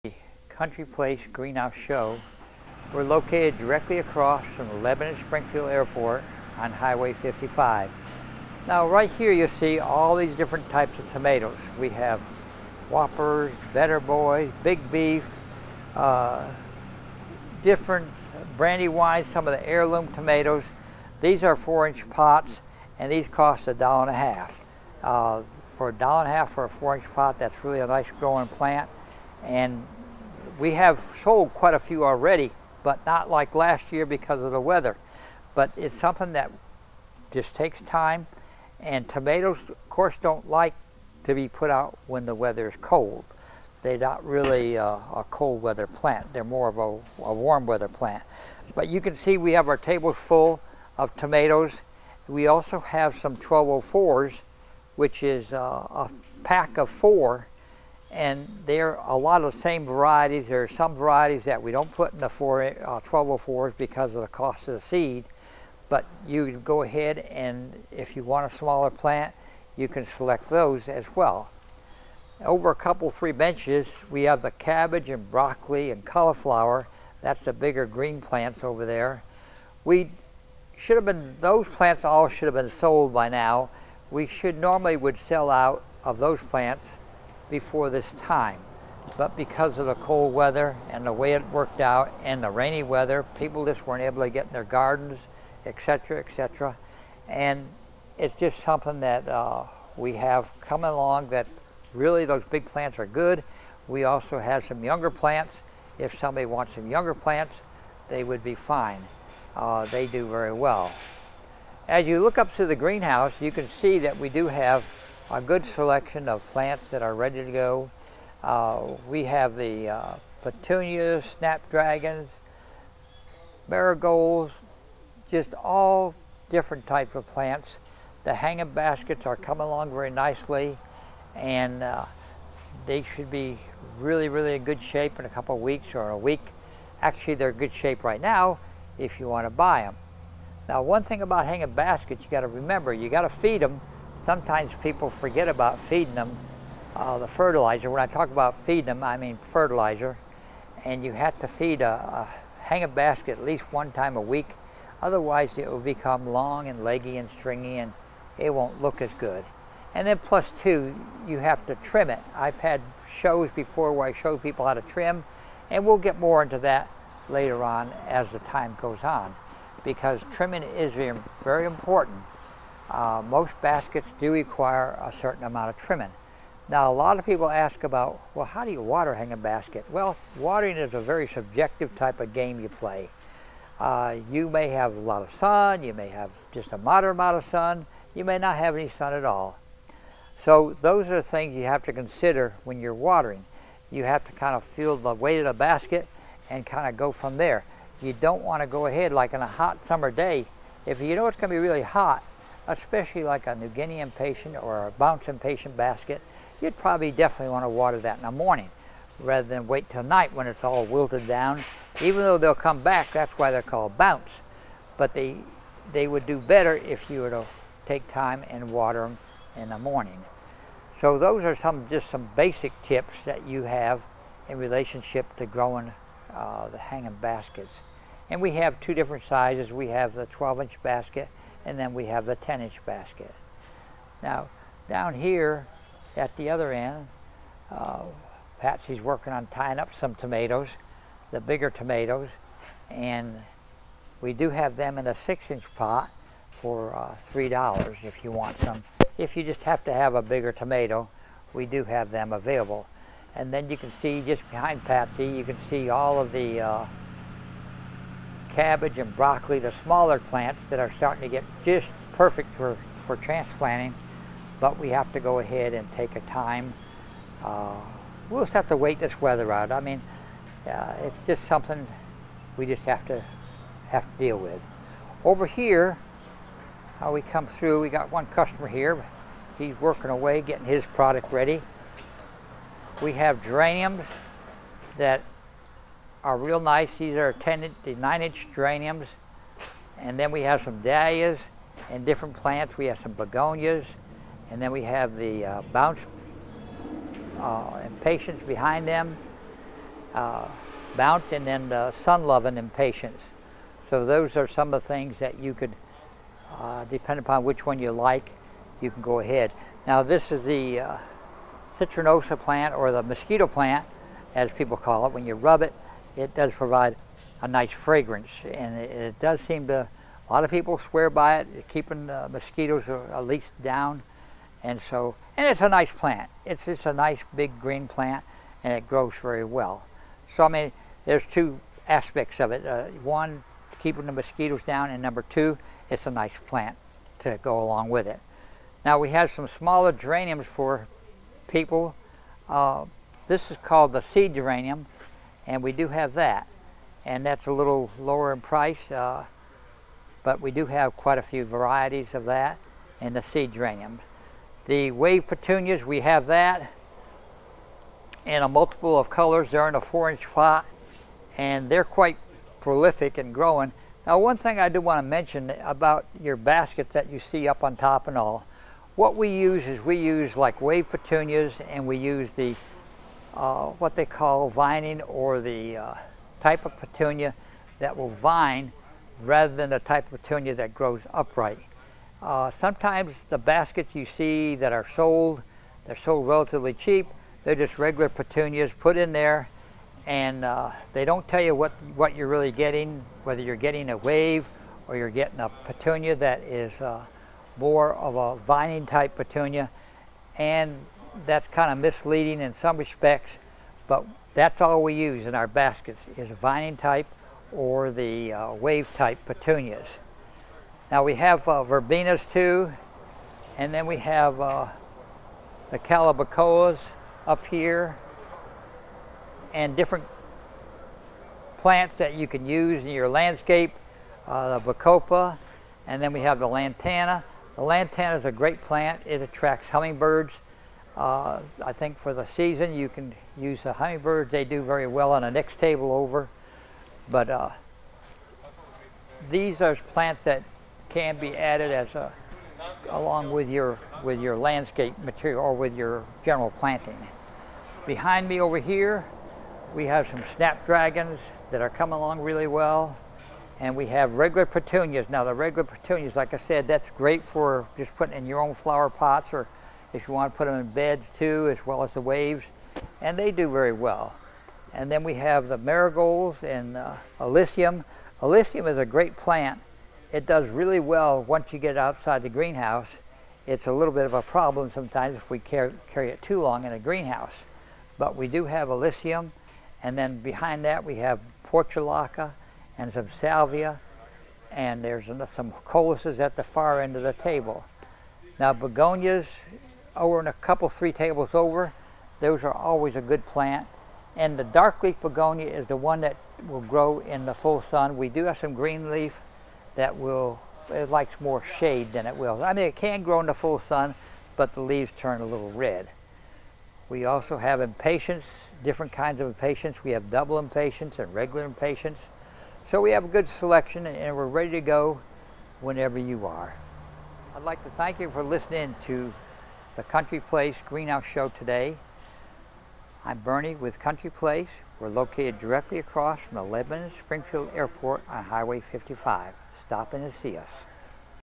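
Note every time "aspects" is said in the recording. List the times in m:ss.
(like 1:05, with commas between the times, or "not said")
5:31.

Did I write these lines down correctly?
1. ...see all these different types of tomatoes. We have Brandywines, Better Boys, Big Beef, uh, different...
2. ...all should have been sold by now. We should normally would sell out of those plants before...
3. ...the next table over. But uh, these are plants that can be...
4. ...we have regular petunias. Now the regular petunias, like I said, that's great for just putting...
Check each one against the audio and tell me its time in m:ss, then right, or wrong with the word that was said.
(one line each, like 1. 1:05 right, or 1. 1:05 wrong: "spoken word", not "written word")
1. 0:09 wrong: "Whoppers", not "Brandywines"
2. 1:22 right
3. 7:15 right
4. 7:33 right.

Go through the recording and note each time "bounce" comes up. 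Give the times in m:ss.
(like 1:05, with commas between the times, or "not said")
3:24, 3:33, 4:55, 5:00.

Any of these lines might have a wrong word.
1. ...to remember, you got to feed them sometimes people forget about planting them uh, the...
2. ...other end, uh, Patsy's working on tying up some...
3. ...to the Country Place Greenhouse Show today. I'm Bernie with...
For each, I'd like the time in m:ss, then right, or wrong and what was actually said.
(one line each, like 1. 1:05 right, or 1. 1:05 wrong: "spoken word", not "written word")
1. 2:22 wrong: "feeding", not "planting"
2. 3:56 right
3. 8:38 right.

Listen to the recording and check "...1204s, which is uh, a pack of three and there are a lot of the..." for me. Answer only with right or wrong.
wrong.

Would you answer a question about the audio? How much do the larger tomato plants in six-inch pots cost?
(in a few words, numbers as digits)
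$3.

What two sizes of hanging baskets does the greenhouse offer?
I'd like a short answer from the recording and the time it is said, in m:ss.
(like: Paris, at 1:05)
12 inch and 10 inch, at 3:50.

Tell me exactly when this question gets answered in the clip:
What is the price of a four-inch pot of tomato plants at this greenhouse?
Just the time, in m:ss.
0:23.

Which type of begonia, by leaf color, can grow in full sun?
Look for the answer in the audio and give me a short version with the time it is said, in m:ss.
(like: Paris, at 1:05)
dark leaf begonia, at 8:14.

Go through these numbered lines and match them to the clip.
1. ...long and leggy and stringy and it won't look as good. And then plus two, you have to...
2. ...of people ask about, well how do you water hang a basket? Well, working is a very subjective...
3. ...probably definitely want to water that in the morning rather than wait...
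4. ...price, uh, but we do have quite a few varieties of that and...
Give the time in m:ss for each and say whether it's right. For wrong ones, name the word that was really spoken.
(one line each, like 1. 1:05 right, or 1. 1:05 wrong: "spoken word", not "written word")
1. 2:36 right
2. 2:57 wrong: "watering", not "working"
3. 3:26 right
4. 5:48 right.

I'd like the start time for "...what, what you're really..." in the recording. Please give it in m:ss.
6:31.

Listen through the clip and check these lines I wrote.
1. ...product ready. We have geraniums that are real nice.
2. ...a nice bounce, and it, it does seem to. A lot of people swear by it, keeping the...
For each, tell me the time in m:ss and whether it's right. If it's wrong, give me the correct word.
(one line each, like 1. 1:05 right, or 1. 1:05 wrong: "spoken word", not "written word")
1. 4:40 right
2. 5:17 wrong: "fragrance", not "bounce".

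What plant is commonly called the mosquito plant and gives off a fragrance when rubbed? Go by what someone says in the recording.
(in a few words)
citronosa.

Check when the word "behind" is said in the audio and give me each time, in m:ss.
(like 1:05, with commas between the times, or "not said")
4:14, 4:58, 7:27, 8:00.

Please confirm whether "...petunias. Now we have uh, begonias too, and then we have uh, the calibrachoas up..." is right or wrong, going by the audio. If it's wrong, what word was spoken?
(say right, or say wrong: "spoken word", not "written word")
wrong: "verbenas", not "begonias".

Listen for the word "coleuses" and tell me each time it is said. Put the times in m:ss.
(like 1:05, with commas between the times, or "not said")
8:05.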